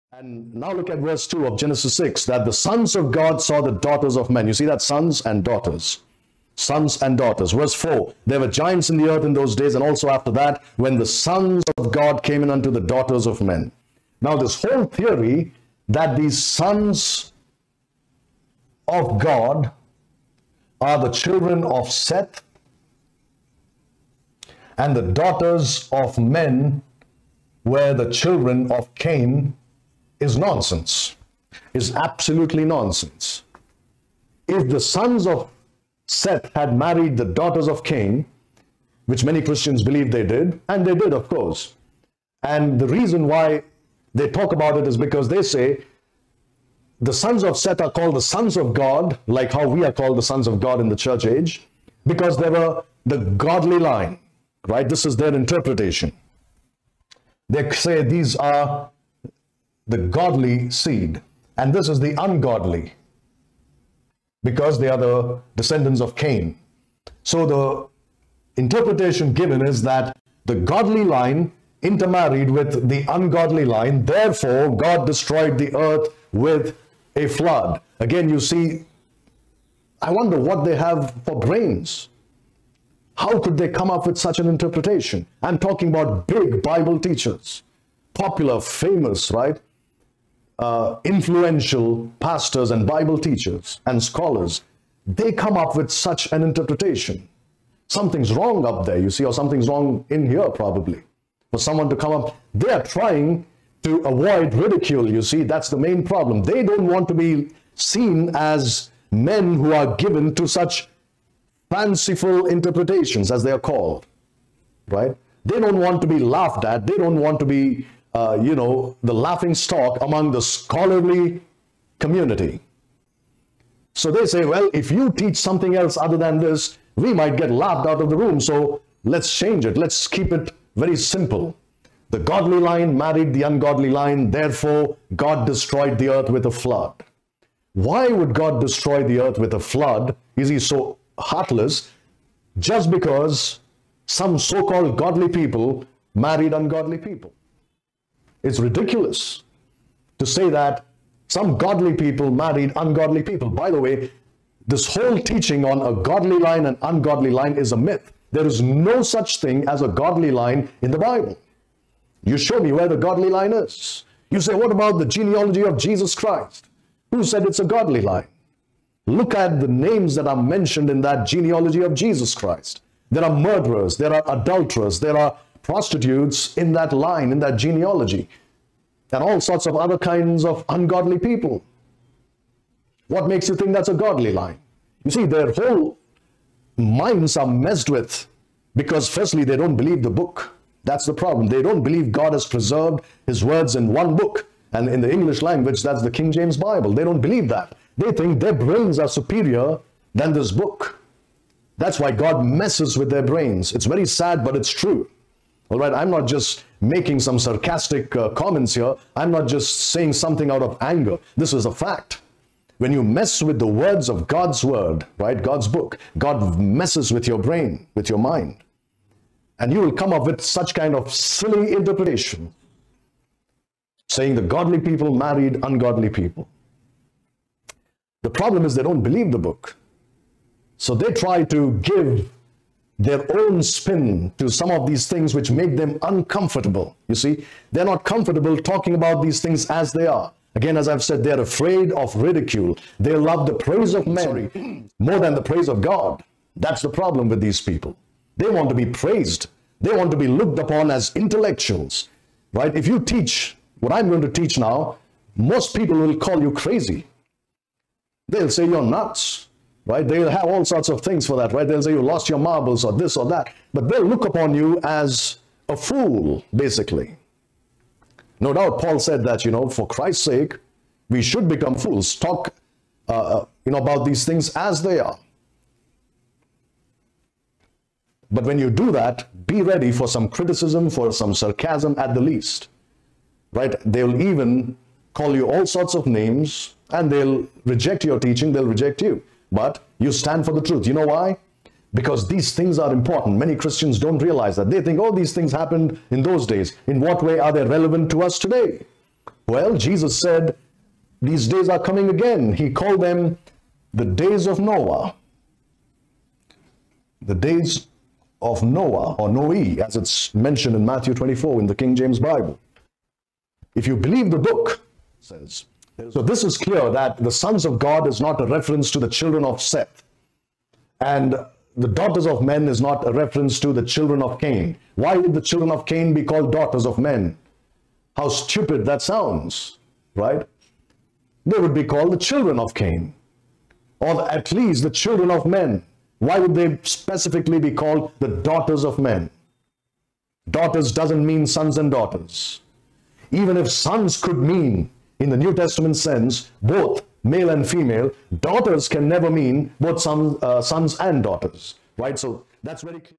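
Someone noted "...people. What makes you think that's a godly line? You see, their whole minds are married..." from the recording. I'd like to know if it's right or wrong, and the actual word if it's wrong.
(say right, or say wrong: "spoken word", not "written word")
wrong: "messed", not "married".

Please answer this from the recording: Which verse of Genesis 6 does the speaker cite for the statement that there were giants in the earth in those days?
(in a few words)
Verse 4.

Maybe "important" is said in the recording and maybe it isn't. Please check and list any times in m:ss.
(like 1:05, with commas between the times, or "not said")
4:52.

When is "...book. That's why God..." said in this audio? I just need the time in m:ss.
3:20.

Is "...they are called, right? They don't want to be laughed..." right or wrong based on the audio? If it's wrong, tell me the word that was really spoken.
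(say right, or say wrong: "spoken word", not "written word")
right.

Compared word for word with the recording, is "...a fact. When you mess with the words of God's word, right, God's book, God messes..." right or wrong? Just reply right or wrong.
right.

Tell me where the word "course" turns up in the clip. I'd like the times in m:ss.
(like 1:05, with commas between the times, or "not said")
0:41.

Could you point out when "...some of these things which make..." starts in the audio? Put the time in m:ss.
3:54.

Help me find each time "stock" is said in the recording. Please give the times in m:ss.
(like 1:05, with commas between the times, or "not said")
1:59.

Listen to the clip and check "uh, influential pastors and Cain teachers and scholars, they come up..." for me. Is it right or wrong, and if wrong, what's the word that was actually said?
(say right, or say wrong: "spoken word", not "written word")
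wrong: "Bible", not "Cain".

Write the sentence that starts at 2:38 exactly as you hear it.
There is no such thing as a godly line in the Bible.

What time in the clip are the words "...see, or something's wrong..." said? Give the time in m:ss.
1:39.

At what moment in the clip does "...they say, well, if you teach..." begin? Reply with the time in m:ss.
2:04.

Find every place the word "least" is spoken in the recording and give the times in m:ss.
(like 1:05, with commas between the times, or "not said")
4:42, 5:34.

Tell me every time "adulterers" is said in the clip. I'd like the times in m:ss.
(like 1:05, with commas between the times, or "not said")
2:54.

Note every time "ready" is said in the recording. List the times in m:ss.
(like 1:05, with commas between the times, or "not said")
4:39.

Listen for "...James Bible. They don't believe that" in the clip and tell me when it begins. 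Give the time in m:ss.
3:16.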